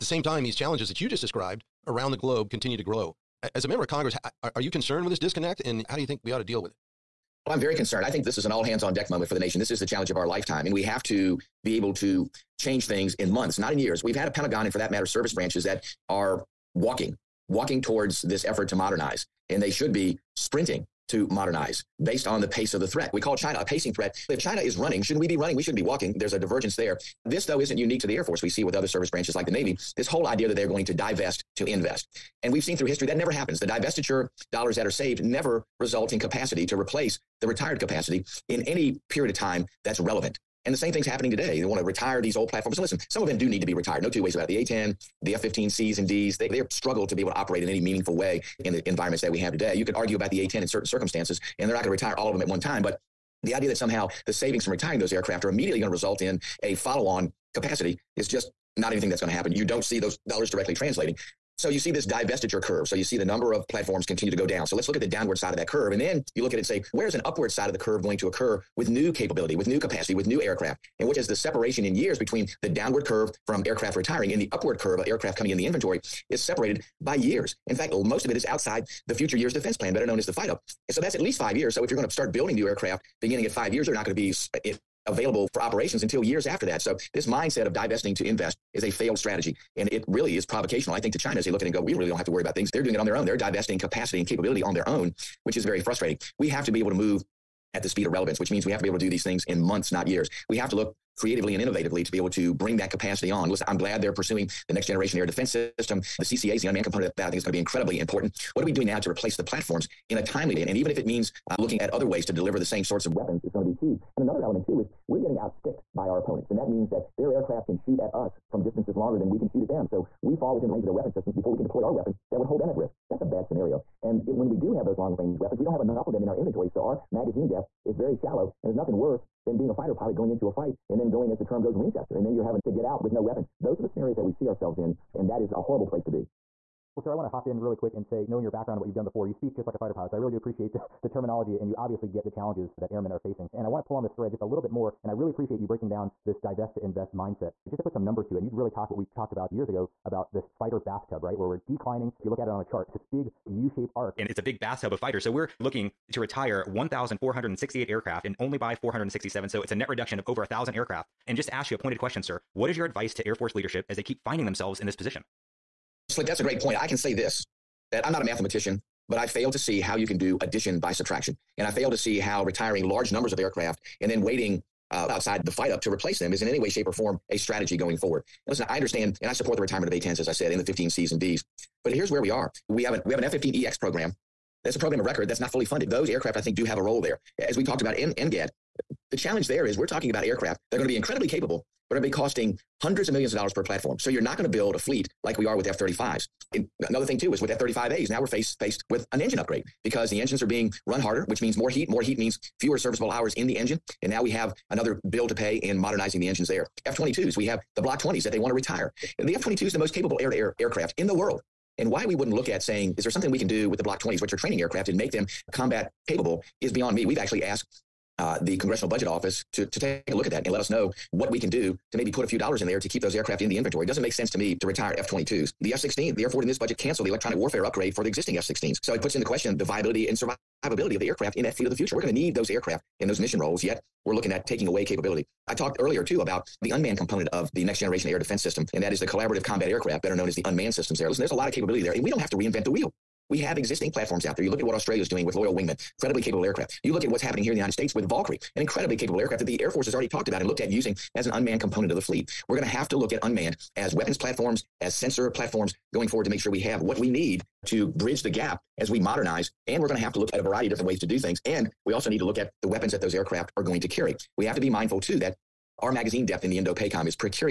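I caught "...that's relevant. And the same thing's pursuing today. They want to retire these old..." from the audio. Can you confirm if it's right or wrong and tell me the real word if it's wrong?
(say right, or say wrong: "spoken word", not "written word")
wrong: "happening", not "pursuing".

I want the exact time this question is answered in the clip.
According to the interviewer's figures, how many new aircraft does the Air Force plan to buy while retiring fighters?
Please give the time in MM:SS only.
02:38.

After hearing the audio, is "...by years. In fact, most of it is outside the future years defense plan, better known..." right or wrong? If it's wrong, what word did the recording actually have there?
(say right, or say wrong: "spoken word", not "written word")
right.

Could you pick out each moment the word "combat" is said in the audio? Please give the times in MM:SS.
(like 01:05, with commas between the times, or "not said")
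03:35, 03:59.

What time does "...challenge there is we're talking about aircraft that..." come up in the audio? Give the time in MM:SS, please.
03:09.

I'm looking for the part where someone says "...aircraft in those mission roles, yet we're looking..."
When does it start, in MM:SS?
03:52.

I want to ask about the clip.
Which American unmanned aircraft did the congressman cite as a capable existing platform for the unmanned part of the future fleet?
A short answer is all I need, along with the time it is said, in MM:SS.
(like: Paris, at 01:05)
Valkyrie, at 04:08.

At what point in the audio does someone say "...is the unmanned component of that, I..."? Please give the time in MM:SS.
01:46.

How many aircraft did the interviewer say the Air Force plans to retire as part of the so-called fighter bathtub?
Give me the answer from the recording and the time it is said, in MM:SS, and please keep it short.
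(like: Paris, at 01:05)
1,468, at 02:36.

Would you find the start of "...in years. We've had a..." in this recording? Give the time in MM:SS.
00:13.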